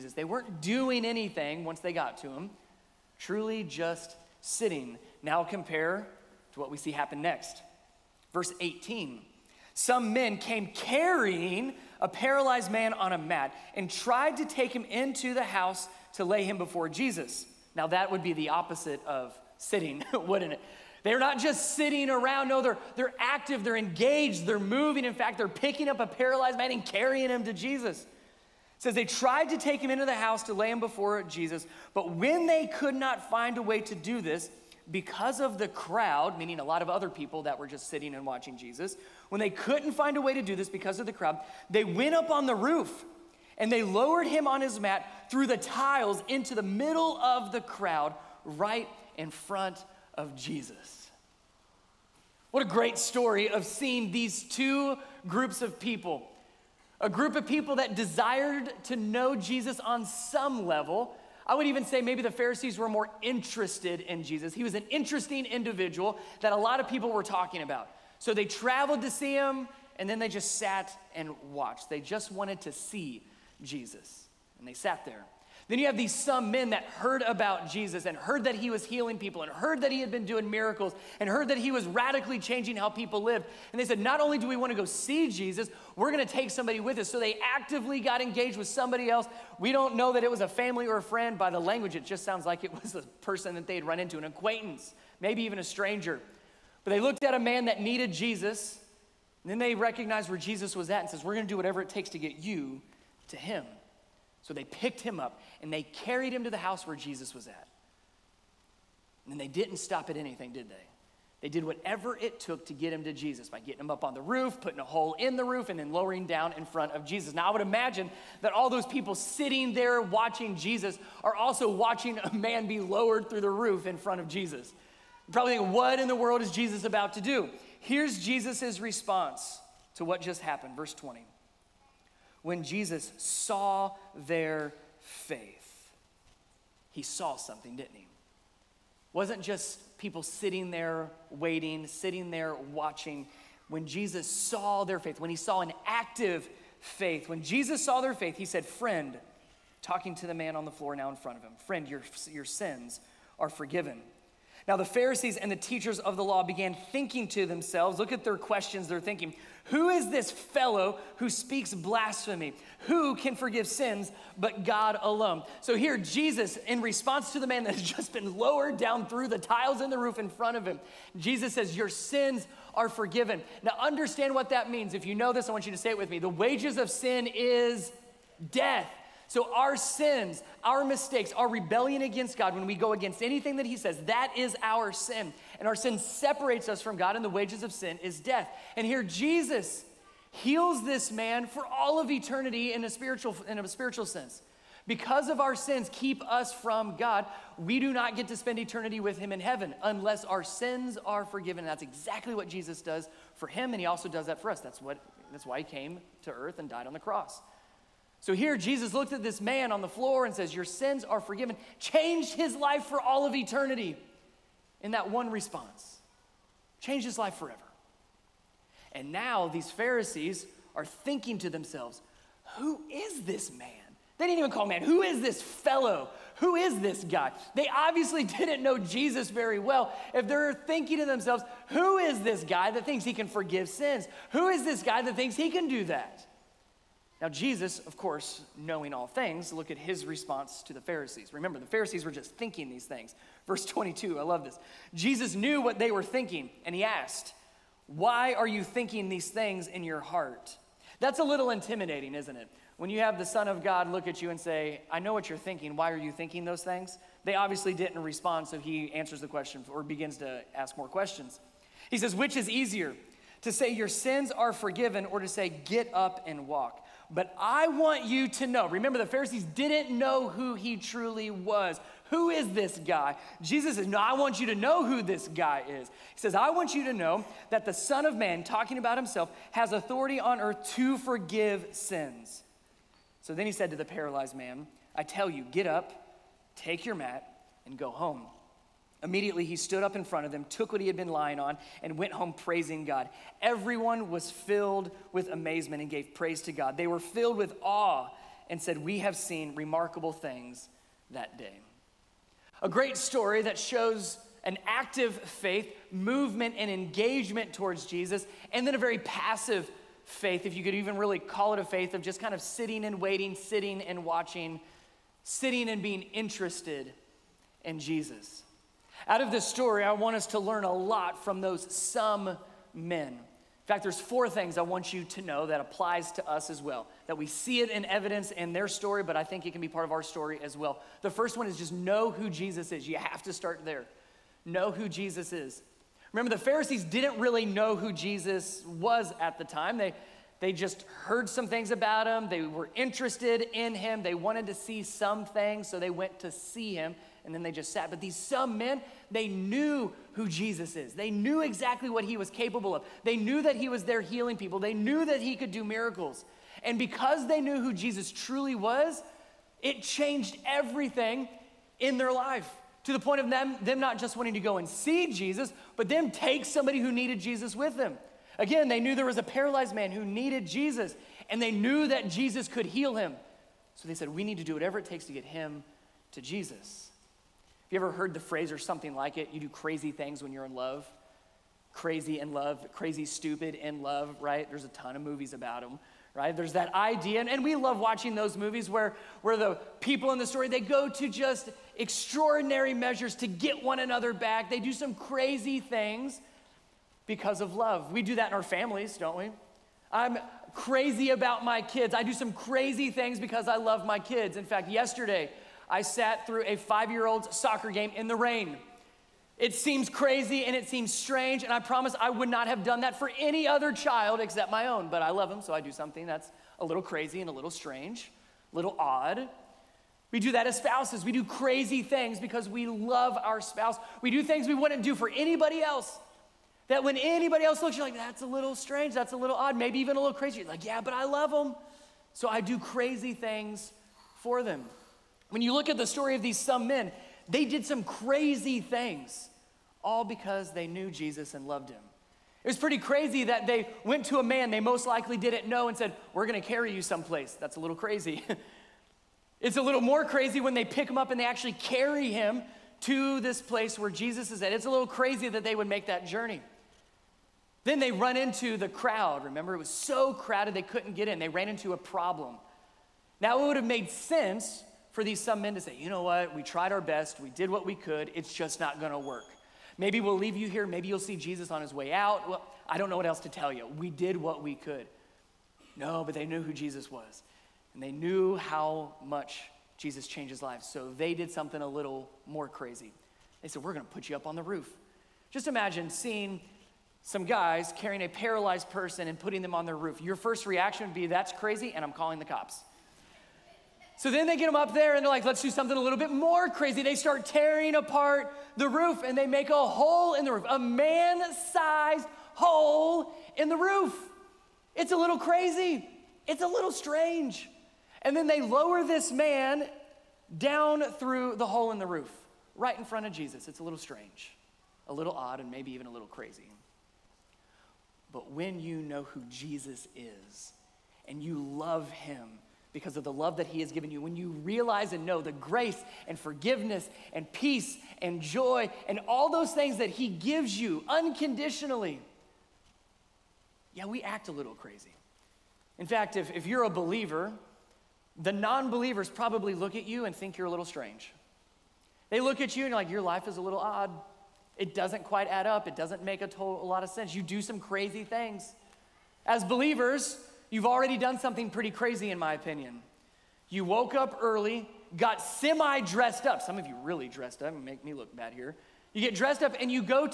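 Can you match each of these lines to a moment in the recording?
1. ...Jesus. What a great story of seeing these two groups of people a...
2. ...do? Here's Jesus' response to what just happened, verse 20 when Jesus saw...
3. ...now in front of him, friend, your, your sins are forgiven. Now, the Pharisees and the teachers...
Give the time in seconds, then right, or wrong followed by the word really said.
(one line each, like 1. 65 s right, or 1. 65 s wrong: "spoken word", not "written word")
1. 50 s right
2. 127 s right
3. 150 s right.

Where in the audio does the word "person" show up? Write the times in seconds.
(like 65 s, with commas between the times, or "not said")
93 s, 488 s.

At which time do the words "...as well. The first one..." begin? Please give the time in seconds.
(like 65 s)
330 s.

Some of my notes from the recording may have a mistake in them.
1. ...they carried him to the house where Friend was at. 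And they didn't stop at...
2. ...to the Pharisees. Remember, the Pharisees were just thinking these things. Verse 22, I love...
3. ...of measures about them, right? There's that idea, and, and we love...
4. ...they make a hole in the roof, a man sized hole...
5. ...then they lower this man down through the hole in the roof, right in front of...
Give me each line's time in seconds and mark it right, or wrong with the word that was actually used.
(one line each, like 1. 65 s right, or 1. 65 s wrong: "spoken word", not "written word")
1. 105 s wrong: "Jesus", not "Friend"
2. 240 s right
3. 384 s wrong: "movies", not "measures"
4. 499 s right
5. 508 s right.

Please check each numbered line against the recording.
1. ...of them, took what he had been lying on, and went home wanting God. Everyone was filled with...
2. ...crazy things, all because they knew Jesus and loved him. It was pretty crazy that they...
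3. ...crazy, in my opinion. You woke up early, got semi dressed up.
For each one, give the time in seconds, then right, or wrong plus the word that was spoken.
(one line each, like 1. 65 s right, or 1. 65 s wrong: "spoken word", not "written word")
1. 290 s wrong: "praising", not "wanting"
2. 437 s right
3. 551 s right.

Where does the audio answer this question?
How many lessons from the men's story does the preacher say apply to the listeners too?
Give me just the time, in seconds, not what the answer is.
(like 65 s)
323 s.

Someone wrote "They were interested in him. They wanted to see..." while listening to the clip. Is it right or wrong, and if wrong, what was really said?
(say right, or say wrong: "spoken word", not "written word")
right.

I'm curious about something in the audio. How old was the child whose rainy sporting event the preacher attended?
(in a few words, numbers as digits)
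5.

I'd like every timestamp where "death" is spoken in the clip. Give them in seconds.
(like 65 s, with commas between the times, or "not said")
178 s, 188 s.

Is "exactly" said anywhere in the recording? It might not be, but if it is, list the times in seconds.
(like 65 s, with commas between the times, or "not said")
201 s, 351 s.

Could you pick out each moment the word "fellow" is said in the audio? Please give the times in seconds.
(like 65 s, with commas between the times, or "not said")
160 s, 225 s.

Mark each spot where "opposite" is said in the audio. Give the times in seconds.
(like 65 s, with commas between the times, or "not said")
18 s.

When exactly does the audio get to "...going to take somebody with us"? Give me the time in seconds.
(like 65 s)
86 s.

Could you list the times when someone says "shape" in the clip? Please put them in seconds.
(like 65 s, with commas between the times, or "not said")
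not said.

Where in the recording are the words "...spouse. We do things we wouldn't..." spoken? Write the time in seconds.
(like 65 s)
423 s.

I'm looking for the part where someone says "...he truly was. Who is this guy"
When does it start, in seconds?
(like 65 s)
270 s.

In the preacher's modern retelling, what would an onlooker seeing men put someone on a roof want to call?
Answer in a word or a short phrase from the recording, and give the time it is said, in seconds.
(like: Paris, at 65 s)
The cops, at 491 s.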